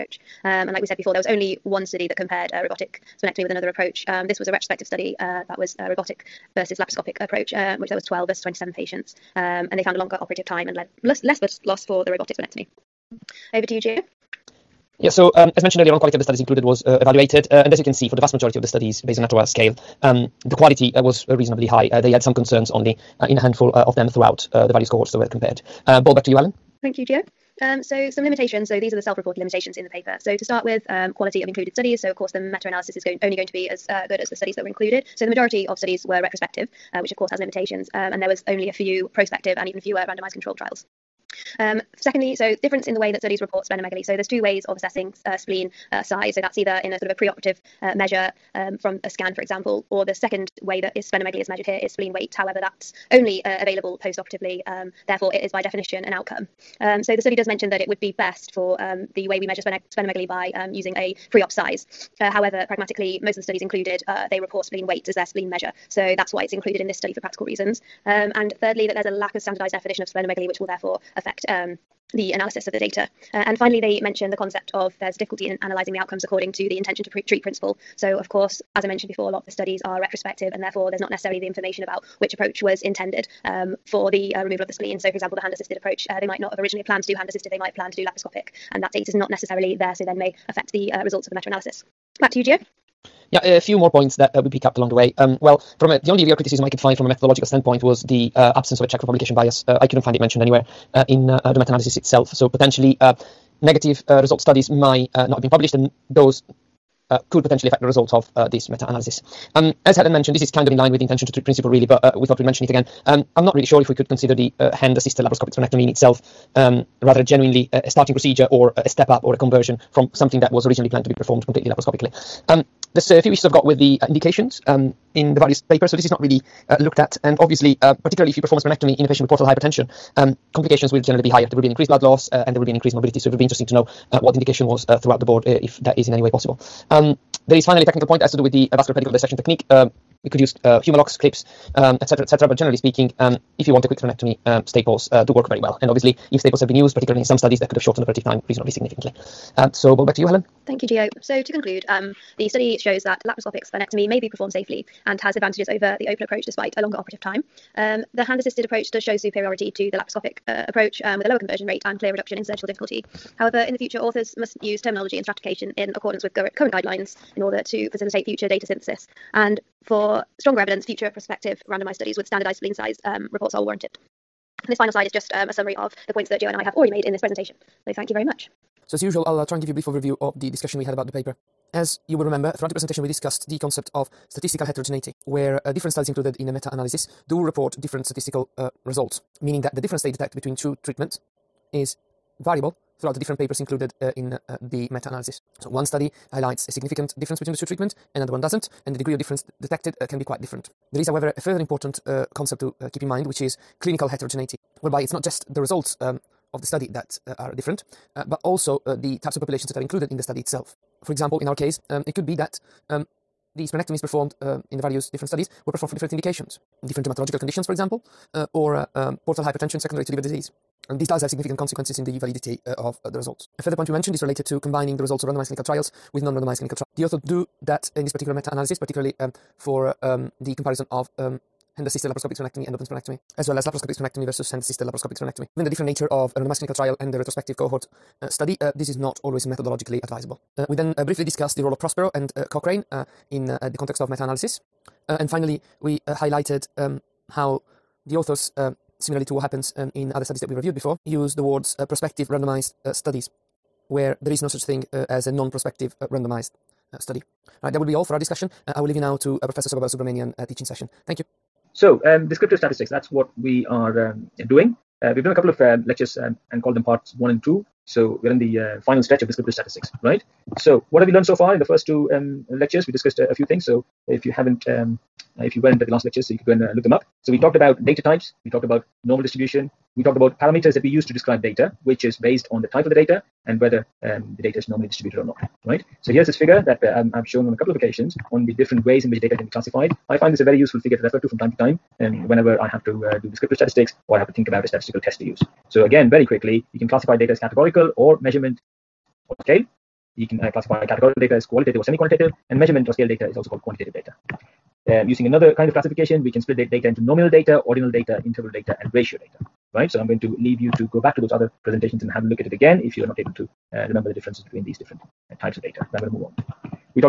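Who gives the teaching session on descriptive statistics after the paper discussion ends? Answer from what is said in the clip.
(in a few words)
Saba Balasubramanian.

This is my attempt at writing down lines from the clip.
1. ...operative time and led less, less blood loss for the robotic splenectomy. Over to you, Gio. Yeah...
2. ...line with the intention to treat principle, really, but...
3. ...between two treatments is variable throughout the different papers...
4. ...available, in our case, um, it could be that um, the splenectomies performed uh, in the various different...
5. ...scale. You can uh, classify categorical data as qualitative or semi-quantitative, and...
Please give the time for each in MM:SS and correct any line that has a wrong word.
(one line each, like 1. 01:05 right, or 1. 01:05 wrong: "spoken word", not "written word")
1. 00:10 right
2. 01:50 right
3. 03:10 right
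4. 03:31 wrong: "example", not "available"
5. 04:59 right.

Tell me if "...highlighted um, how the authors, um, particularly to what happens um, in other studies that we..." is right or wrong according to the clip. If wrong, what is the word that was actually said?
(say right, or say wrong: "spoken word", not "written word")
wrong: "similarly", not "particularly".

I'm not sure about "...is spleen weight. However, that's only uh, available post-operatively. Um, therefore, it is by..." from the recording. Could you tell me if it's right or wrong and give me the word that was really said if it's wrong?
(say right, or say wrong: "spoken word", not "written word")
right.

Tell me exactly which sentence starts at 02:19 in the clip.
Um, we could use uh, Hem-o-loks, clips, etc., um, etc.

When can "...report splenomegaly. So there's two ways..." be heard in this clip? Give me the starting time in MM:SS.
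00:43.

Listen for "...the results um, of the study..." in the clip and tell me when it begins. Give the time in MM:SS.
03:25.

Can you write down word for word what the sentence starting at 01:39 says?
Uh, I couldn't find it mentioned anywhere uh, in uh, uh, the meta-analysis itself.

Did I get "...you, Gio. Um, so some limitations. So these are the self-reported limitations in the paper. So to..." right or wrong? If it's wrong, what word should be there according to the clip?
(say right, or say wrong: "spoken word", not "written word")
right.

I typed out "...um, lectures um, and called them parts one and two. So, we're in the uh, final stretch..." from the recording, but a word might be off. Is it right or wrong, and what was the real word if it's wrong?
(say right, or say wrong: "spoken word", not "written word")
right.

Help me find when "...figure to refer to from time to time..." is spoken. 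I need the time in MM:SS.
04:50.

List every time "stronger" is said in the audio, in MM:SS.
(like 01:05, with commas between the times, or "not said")
02:50.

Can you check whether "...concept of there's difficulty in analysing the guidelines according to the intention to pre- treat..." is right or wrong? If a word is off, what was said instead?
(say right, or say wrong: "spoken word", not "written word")
wrong: "outcomes", not "guidelines".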